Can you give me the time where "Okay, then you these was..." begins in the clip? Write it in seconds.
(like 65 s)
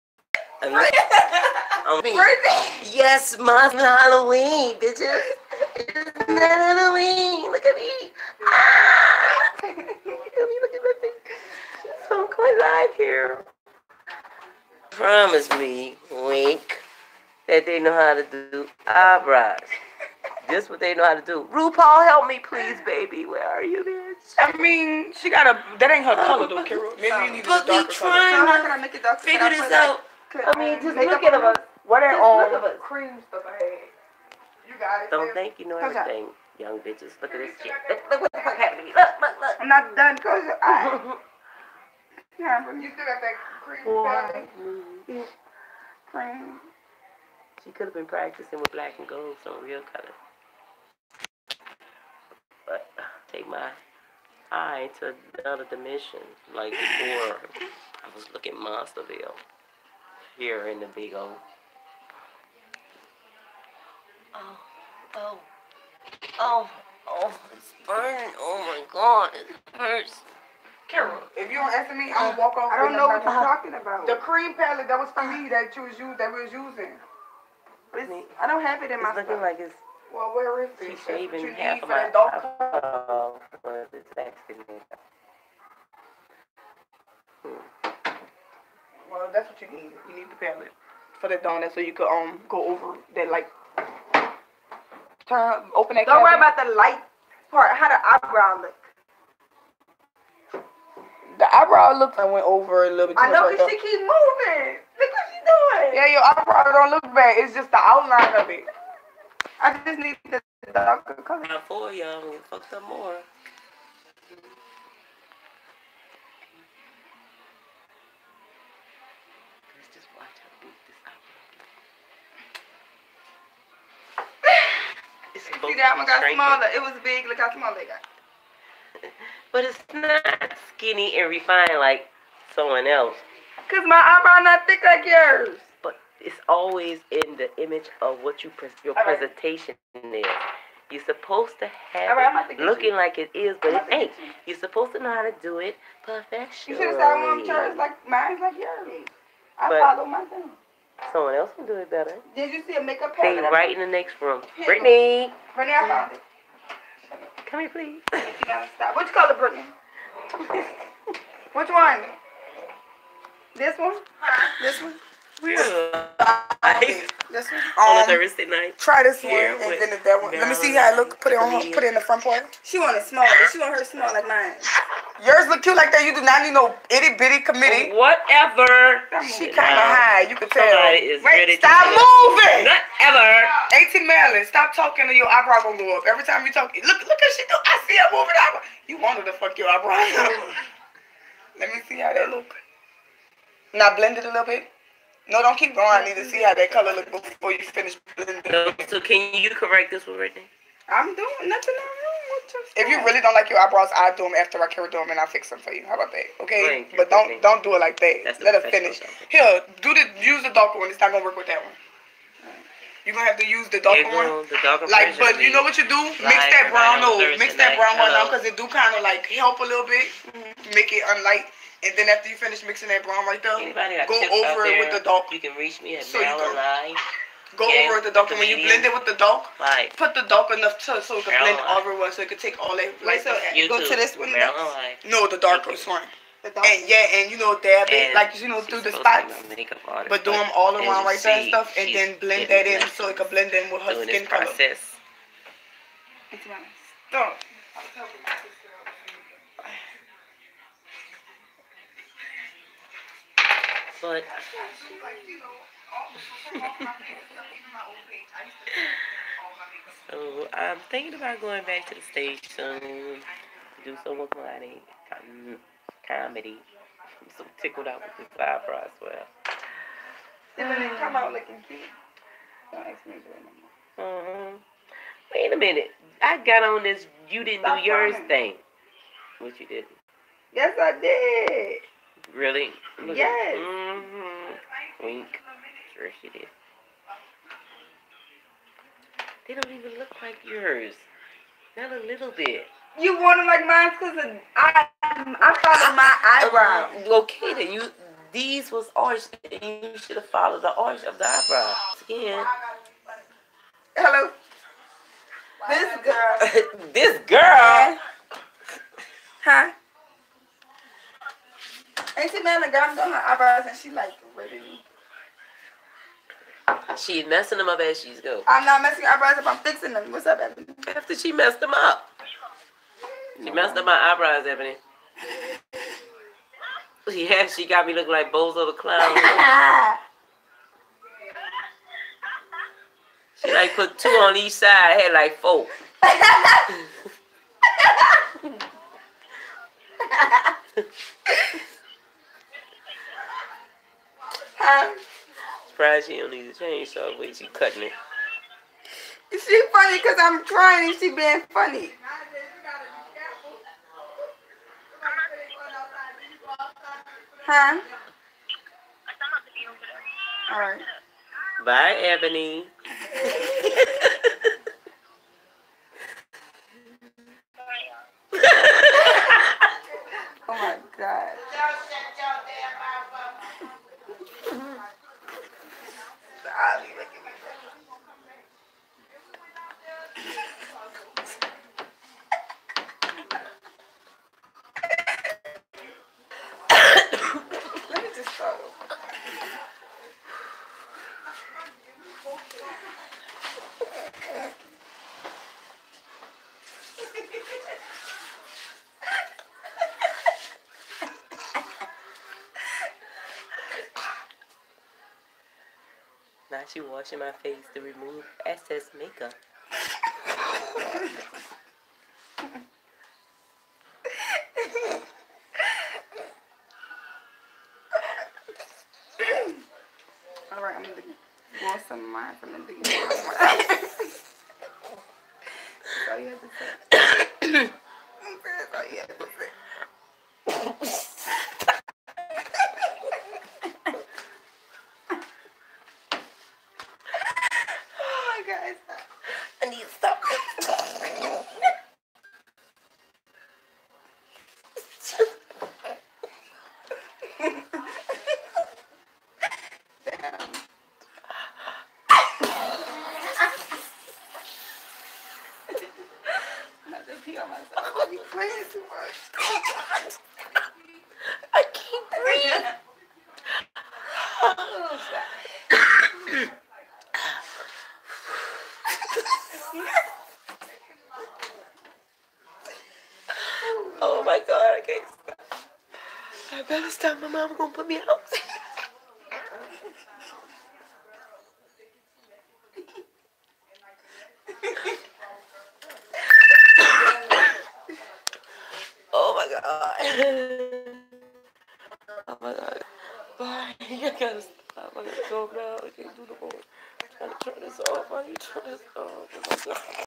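297 s.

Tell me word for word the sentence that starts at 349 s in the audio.
Is she funny because I'm trying and she being funny?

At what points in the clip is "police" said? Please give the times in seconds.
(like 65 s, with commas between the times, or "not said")
not said.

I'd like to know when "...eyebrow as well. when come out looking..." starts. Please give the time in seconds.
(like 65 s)
268 s.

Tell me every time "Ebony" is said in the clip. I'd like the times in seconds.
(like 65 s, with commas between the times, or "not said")
320 s, 324 s, 362 s.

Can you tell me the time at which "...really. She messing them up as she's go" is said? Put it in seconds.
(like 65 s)
314 s.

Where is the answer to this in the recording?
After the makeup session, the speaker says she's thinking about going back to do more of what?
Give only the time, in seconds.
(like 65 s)
264 s.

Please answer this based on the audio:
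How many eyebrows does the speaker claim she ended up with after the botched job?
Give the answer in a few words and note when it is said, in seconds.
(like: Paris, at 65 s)
4, at 335 s.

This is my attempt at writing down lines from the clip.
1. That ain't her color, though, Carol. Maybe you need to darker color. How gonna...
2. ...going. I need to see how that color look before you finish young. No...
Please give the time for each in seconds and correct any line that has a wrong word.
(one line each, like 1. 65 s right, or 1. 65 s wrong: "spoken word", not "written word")
1. 25 s right
2. 195 s wrong: "blending", not "young".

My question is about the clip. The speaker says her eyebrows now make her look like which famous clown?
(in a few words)
Bozo the Clown.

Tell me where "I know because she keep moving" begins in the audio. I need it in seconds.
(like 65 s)
103 s.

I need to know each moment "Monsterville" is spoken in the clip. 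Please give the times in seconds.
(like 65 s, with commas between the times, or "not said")
58 s.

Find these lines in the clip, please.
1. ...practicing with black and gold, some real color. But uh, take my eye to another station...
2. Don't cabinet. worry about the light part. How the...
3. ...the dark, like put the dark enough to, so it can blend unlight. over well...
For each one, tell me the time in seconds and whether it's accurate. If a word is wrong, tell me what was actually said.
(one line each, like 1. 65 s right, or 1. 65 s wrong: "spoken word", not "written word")
1. 48 s wrong: "dimension", not "station"
2. 96 s right
3. 229 s wrong: "light", not "unlight".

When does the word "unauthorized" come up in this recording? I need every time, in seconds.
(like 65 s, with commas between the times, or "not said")
not said.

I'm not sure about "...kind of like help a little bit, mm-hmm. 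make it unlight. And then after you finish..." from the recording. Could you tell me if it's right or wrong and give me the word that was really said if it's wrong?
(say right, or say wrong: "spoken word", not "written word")
right.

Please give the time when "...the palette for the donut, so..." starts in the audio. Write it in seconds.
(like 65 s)
90 s.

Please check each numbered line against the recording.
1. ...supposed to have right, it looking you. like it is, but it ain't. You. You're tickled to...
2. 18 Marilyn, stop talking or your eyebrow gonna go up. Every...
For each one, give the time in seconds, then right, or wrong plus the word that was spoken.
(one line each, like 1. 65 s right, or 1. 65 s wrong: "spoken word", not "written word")
1. 141 s wrong: "supposed", not "tickled"
2. 183 s right.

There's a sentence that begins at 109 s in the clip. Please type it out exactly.
I just need the darker color.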